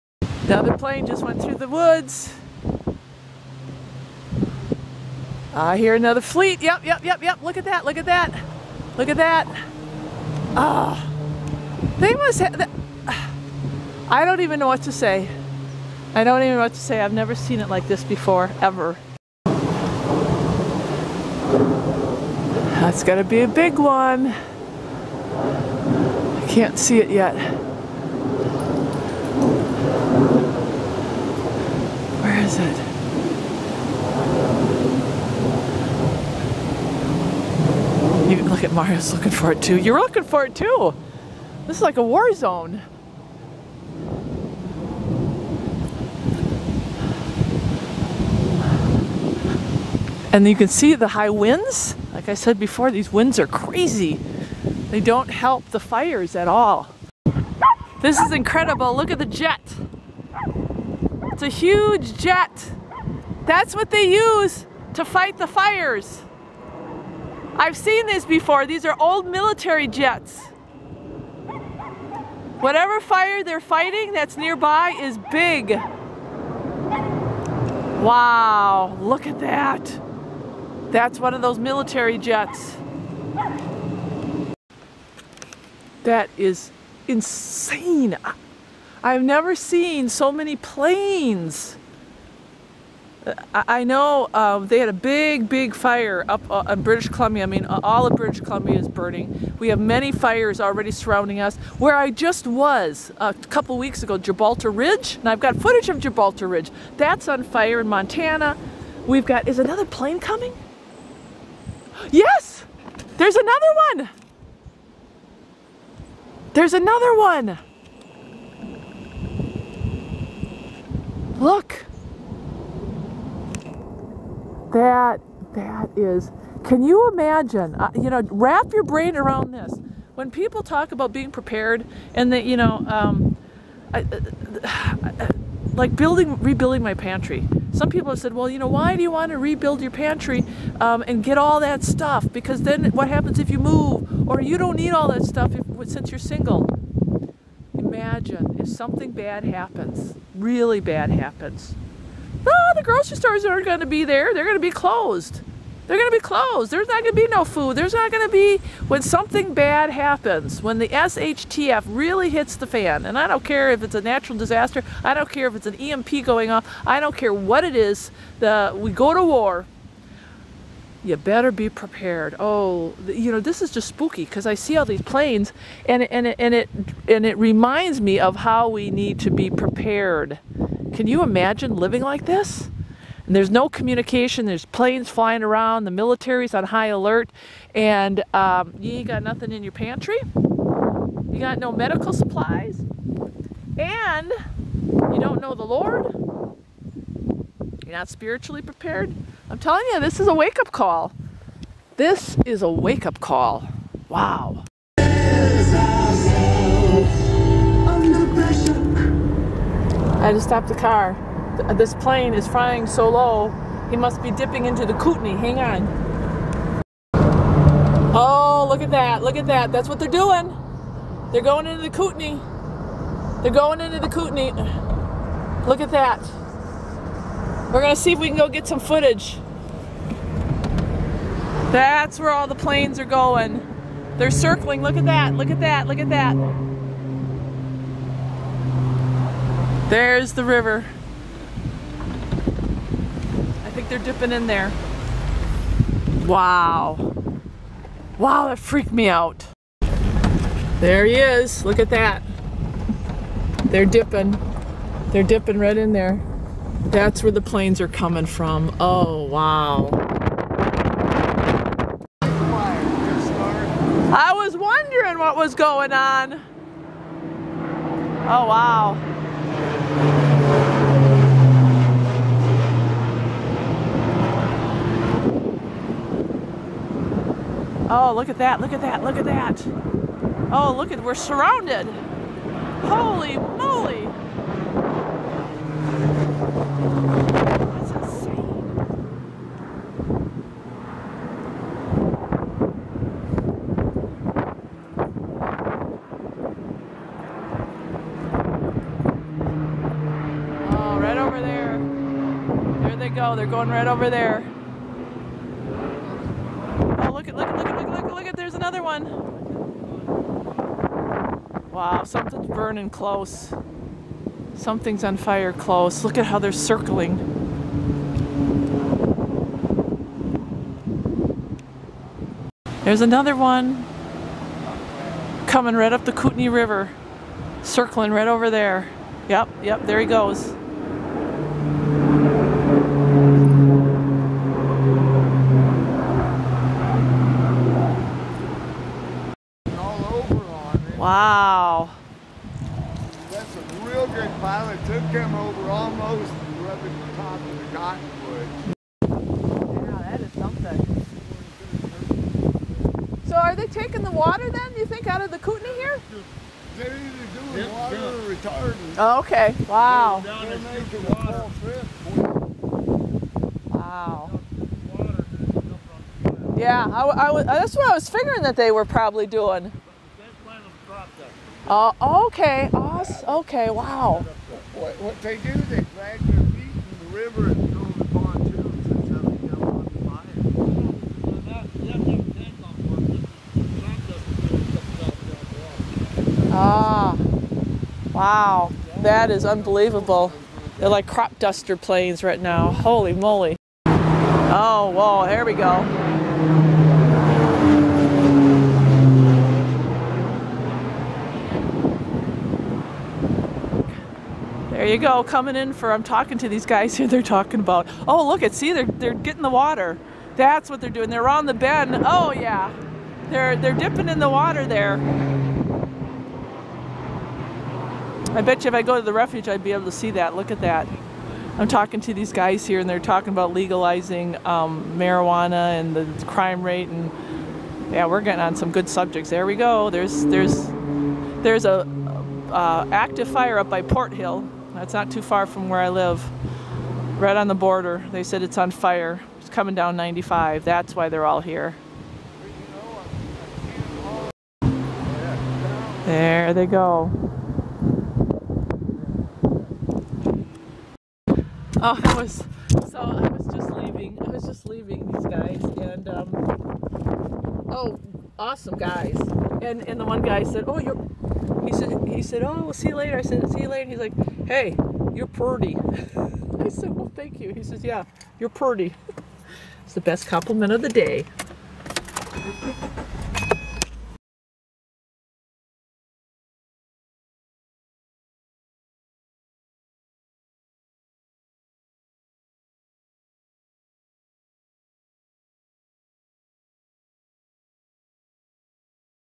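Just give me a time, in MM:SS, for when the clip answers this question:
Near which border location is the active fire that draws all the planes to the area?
07:13.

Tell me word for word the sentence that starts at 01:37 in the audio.
I mean, all of British Columbia is burning.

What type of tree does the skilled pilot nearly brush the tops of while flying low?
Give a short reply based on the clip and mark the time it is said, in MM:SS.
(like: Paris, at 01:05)
Cottonwood, at 05:47.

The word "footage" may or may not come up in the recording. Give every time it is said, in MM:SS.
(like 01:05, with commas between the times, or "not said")
01:45, 03:48.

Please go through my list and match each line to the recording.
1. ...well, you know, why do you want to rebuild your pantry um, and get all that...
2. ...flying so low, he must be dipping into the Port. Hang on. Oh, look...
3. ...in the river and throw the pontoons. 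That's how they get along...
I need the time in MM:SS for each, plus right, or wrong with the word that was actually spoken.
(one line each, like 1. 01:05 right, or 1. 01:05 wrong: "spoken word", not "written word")
1. 02:18 right
2. 03:32 wrong: "Kootenai", not "Port"
3. 06:16 right.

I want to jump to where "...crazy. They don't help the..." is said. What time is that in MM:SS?
00:53.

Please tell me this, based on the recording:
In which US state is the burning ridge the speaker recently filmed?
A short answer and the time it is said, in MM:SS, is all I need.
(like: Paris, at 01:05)
Montana, at 01:47.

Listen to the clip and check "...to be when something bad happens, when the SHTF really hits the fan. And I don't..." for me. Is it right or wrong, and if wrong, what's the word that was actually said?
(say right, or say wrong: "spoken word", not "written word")
right.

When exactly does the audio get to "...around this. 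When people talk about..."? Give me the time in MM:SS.
02:09.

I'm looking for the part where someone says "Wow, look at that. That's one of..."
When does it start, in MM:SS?
01:18.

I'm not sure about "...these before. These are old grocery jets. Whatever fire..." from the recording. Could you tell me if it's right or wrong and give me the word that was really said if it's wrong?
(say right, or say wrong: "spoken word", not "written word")
wrong: "military", not "grocery".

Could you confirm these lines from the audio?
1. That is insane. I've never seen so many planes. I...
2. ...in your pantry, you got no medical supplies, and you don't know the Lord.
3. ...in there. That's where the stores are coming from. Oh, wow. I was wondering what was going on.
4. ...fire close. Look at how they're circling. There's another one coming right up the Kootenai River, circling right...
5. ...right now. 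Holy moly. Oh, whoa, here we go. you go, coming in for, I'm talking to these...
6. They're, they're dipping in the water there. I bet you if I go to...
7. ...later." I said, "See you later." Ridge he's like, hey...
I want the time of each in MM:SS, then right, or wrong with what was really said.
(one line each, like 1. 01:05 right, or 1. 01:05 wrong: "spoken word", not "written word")
1. 01:26 right
2. 03:09 right
3. 04:15 wrong: "planes", not "stores"
4. 05:15 right
5. 06:32 right
6. 06:53 right
7. 07:42 wrong: "And", not "Ridge".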